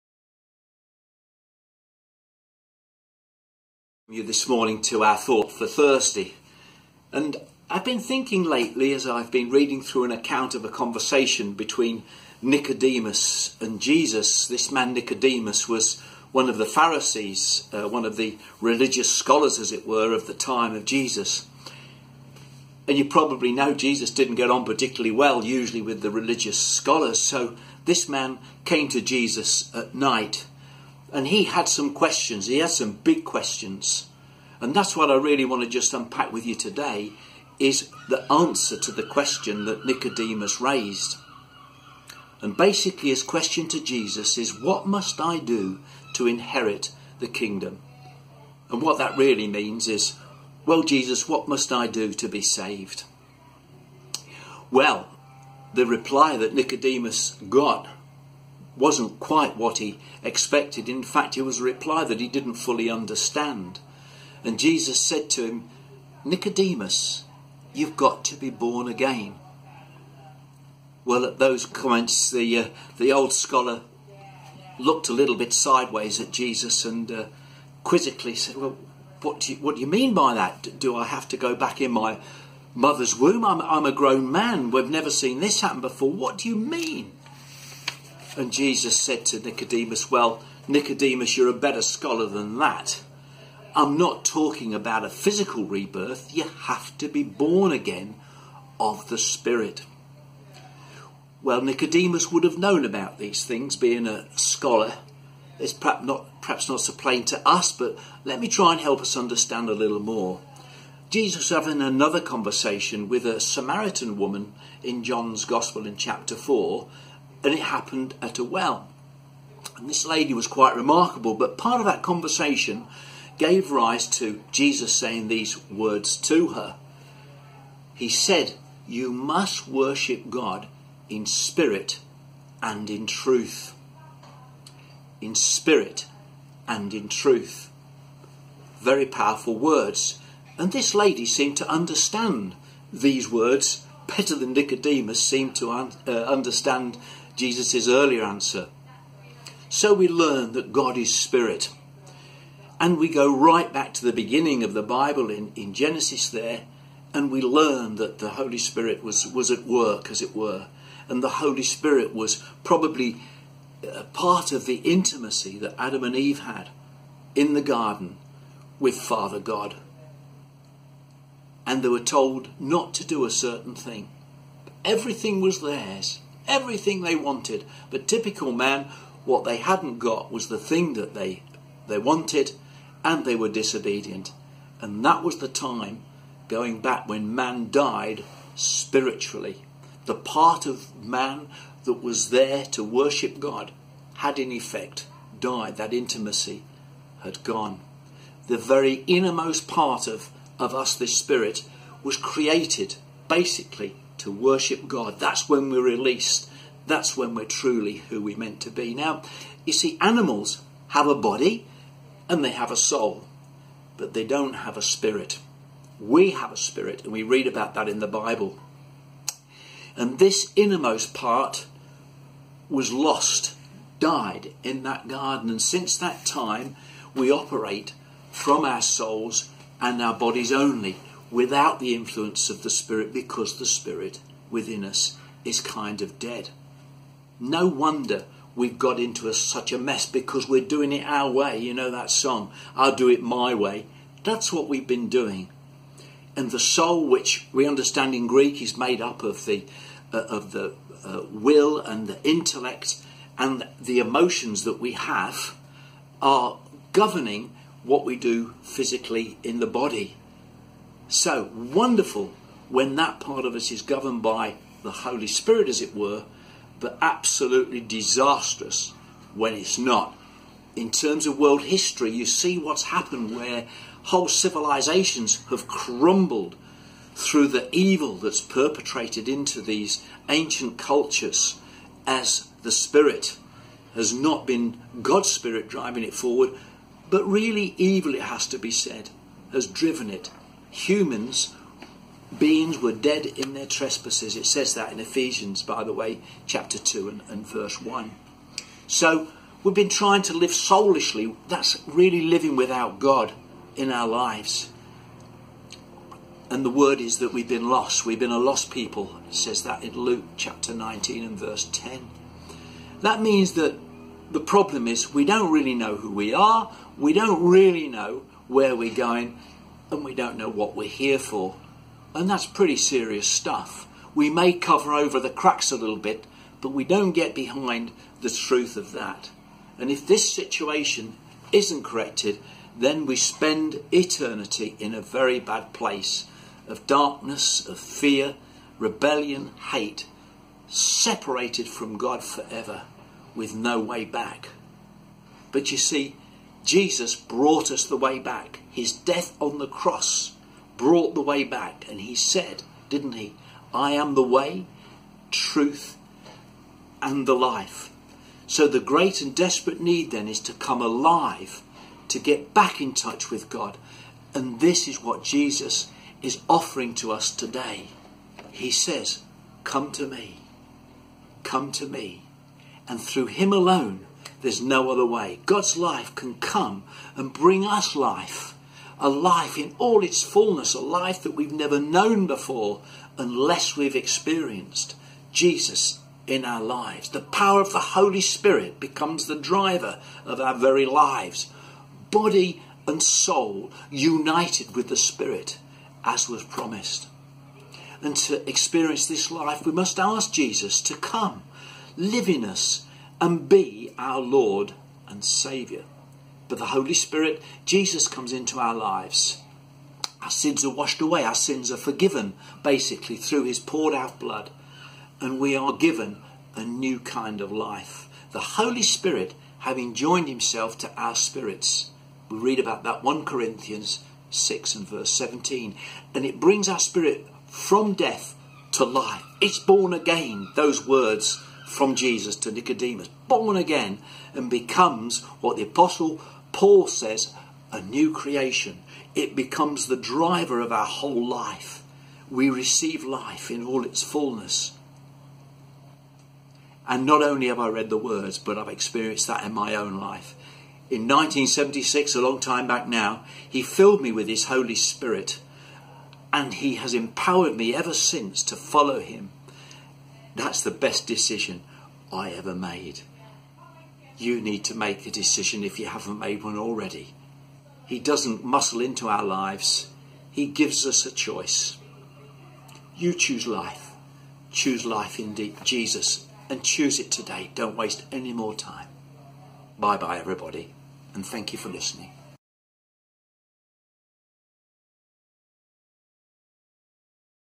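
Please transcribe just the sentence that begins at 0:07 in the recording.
And I've been thinking lately as I've been reading through an account of a conversation between Nicodemus and Jesus.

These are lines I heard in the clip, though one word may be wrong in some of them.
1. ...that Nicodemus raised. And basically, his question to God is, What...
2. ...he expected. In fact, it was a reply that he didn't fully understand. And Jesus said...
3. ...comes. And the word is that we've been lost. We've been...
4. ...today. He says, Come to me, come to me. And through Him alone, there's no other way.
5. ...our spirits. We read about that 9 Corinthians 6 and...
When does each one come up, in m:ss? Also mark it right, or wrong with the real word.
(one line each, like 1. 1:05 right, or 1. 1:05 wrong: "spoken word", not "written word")
1. 0:39 wrong: "Jesus", not "God"
2. 0:59 right
3. 5:04 wrong: "lives", not "comes"
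4. 6:07 right
5. 7:00 wrong: "1", not "9".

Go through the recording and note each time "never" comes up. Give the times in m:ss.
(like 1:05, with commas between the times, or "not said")
1:24, 6:21.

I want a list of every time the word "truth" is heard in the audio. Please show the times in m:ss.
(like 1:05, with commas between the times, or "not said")
2:13, 2:17, 5:28, 5:55.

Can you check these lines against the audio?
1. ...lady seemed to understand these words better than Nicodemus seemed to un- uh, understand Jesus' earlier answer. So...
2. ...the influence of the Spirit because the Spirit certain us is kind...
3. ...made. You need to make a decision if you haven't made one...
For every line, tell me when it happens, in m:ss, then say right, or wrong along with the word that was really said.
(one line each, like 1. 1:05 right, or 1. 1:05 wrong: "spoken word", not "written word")
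1. 2:20 right
2. 3:51 wrong: "within", not "certain"
3. 7:42 right.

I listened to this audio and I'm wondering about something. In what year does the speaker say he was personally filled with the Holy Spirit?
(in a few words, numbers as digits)
1976.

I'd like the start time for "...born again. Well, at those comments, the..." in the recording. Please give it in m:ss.
1:08.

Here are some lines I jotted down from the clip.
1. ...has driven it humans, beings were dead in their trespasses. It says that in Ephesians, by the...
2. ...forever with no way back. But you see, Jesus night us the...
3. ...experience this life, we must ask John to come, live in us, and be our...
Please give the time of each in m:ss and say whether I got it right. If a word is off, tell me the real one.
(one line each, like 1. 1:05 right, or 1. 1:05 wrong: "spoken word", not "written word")
1. 4:49 right
2. 5:42 wrong: "brought", not "night"
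3. 6:38 wrong: "Jesus", not "John".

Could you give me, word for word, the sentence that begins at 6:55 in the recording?
And we are given a new kind of life.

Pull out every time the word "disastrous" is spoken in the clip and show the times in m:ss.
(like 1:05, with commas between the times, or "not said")
4:27.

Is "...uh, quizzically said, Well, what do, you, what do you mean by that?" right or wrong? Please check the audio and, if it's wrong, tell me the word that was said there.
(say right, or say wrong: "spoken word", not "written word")
right.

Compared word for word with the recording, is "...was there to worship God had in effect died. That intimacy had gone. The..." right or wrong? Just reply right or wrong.
right.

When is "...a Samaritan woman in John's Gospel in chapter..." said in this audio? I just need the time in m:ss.
1:53.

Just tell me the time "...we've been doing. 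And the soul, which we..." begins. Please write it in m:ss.
4:04.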